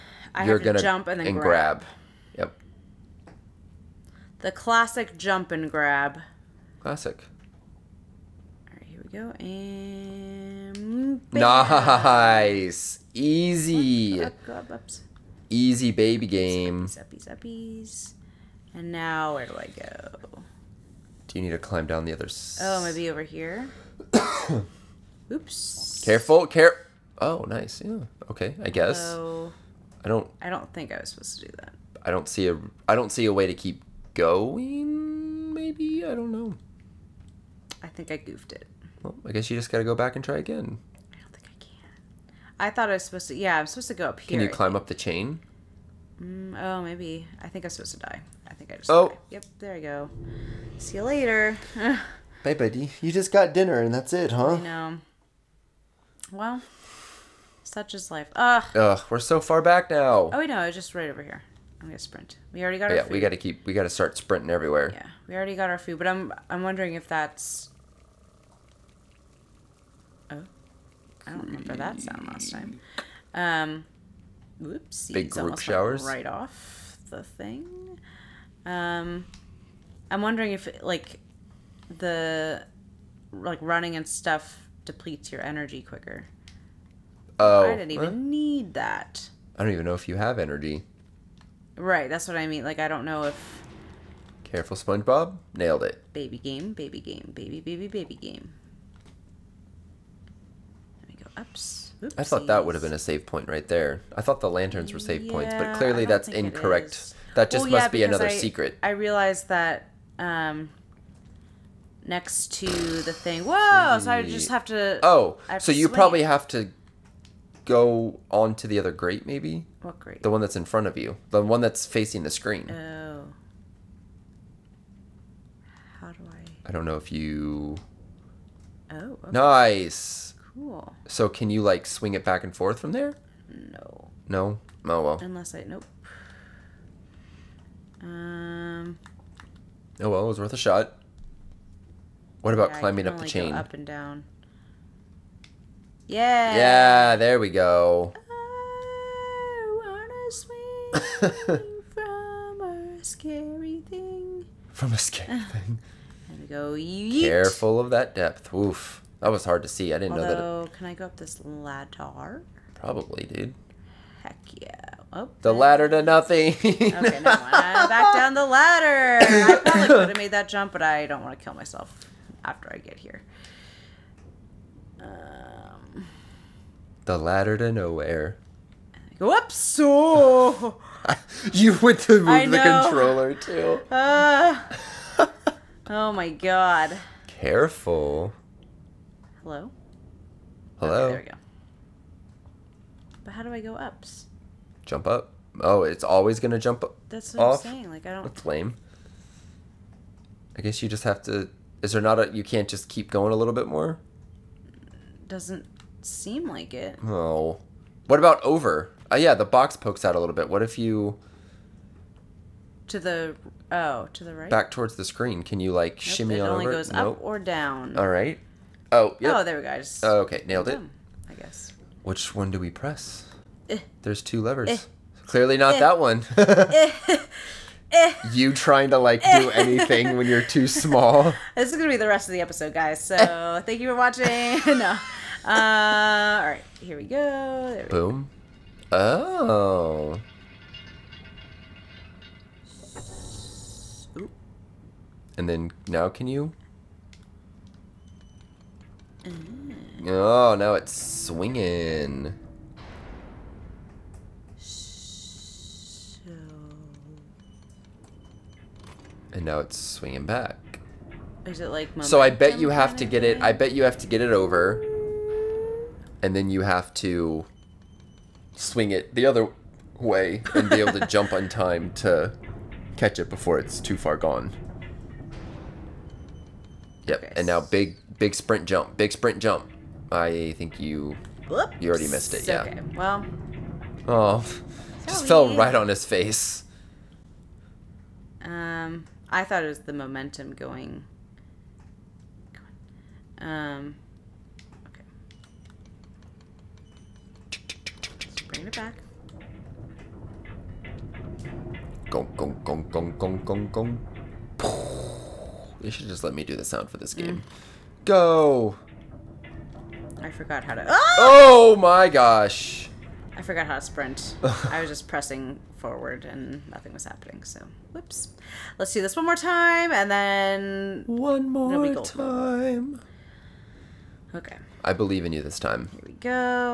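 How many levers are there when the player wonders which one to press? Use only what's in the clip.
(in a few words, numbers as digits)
2.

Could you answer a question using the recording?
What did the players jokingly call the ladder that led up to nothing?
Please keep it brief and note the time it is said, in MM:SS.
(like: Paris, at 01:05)
The ladder to nowhere, at 02:57.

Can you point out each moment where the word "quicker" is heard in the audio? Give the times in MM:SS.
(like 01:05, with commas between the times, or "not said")
01:25.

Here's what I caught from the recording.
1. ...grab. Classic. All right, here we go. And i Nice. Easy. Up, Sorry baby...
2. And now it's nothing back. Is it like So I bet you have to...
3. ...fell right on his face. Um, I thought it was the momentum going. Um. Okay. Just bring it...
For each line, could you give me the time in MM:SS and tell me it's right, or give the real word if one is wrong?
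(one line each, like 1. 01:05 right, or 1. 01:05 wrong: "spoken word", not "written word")
1. 00:05 wrong: "Easy", not "Sorry"
2. 04:19 wrong: "swinging", not "nothing"
3. 04:45 right.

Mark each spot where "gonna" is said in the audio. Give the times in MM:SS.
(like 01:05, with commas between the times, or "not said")
00:00, 01:01, 03:51.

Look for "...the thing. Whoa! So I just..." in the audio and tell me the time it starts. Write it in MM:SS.
01:52.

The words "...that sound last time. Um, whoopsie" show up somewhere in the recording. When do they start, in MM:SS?
01:11.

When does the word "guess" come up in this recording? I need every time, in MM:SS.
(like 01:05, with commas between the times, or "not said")
00:28, 00:39, 03:20, 03:41.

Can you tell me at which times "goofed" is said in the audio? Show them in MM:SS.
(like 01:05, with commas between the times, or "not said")
00:38.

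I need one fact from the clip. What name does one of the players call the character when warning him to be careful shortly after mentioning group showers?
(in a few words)
SpongeBob.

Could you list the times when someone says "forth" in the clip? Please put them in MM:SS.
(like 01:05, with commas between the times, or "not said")
02:12.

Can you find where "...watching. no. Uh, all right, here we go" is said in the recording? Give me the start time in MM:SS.
03:53.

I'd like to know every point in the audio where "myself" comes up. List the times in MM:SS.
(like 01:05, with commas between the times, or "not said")
02:51.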